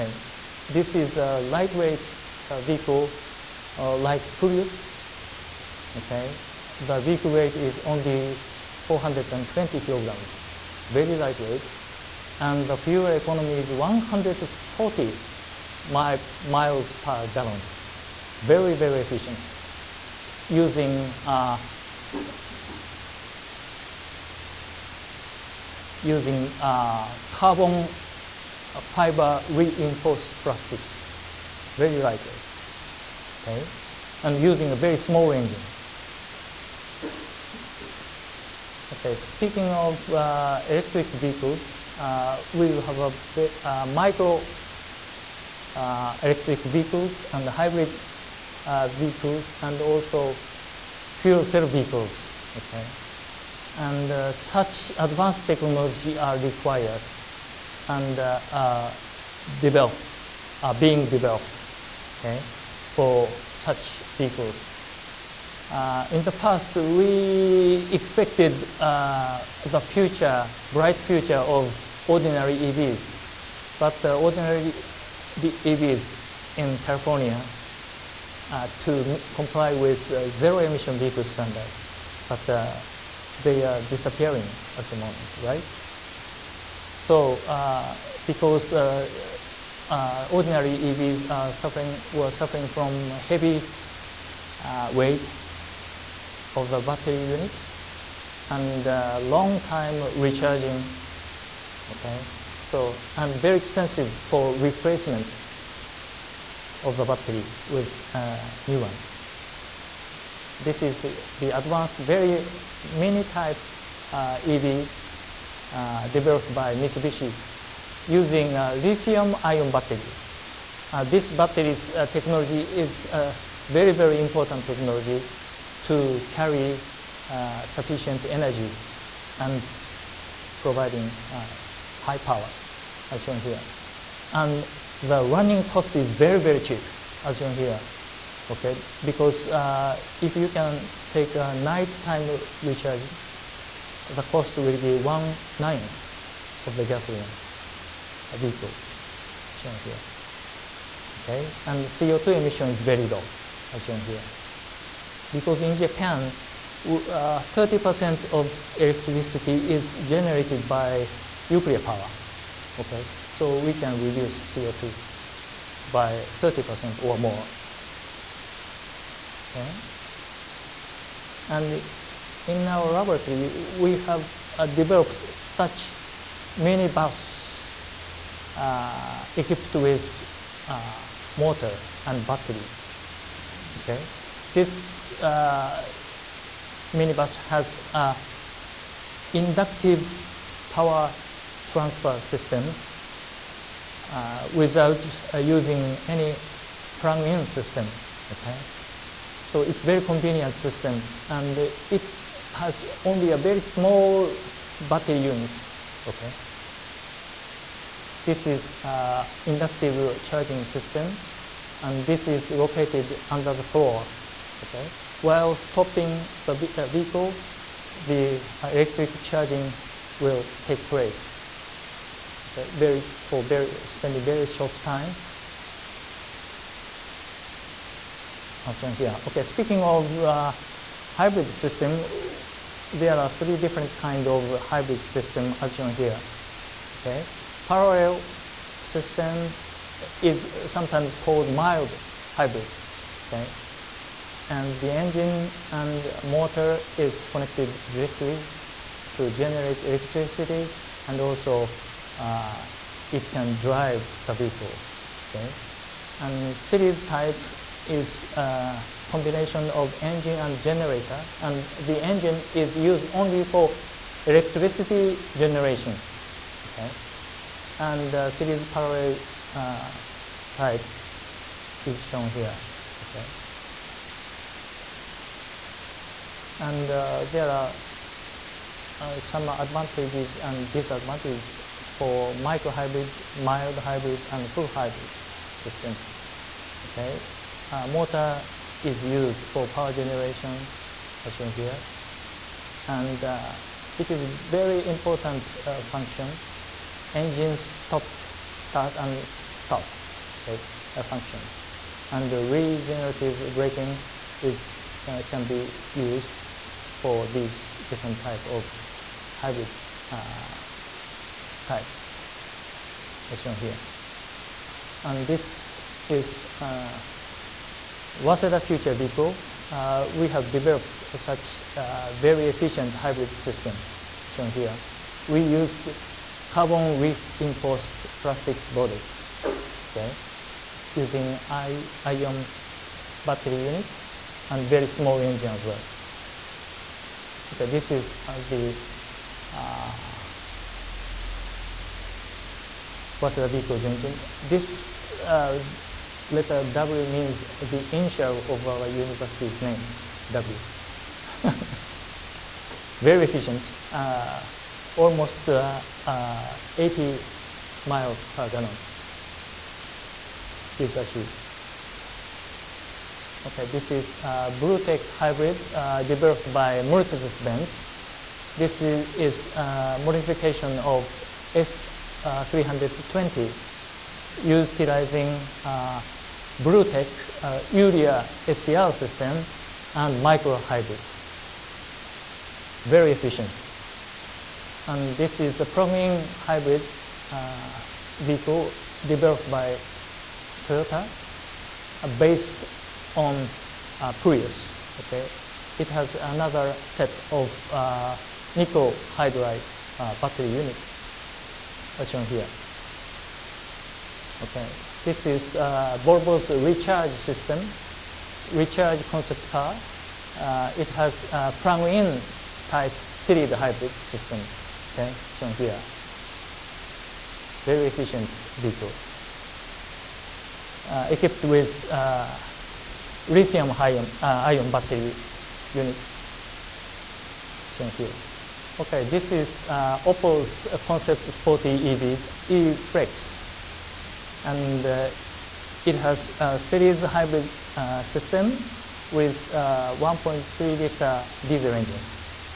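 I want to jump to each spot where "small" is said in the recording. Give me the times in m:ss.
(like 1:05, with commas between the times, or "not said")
0:34, 3:23, 5:34.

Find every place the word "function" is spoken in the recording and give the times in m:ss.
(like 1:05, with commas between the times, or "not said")
4:55, 5:01.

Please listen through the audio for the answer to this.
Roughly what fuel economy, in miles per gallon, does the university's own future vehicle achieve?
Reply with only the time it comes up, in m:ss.
5:56.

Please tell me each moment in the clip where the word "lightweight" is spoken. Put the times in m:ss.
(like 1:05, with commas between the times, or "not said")
0:01, 0:11, 0:32.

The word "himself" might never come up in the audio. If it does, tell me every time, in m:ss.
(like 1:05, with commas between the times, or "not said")
not said.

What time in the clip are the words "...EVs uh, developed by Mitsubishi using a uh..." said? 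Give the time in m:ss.
1:54.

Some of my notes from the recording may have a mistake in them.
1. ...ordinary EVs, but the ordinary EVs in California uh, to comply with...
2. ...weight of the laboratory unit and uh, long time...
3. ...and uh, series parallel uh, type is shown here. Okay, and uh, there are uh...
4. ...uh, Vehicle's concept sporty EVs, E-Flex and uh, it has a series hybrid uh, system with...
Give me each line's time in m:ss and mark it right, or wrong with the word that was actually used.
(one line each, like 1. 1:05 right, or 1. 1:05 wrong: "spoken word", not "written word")
1. 1:12 right
2. 1:34 wrong: "battery", not "laboratory"
3. 4:27 right
4. 7:09 wrong: "Opel", not "Vehicle".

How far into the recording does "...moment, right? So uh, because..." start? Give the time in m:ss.
1:24.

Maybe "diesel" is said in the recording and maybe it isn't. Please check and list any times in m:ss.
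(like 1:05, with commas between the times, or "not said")
7:21.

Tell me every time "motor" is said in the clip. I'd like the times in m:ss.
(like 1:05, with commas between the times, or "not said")
3:01, 4:06, 4:47.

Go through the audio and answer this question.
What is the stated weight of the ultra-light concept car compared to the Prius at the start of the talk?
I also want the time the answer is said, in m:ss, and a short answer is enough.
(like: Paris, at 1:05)
420 kilograms, at 0:08.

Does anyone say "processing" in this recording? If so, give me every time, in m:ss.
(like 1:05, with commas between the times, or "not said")
not said.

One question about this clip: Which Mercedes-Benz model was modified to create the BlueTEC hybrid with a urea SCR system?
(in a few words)
S320.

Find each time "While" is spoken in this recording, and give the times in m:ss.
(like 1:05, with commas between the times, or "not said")
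3:35.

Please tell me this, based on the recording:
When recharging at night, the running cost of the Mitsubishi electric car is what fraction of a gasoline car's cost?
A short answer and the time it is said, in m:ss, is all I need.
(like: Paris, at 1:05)
one ninth, at 2:24.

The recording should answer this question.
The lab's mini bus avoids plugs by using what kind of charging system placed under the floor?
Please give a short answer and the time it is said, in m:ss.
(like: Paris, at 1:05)
inductive power transfer, at 3:09.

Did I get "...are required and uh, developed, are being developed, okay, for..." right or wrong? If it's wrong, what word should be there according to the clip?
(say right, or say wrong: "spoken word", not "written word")
right.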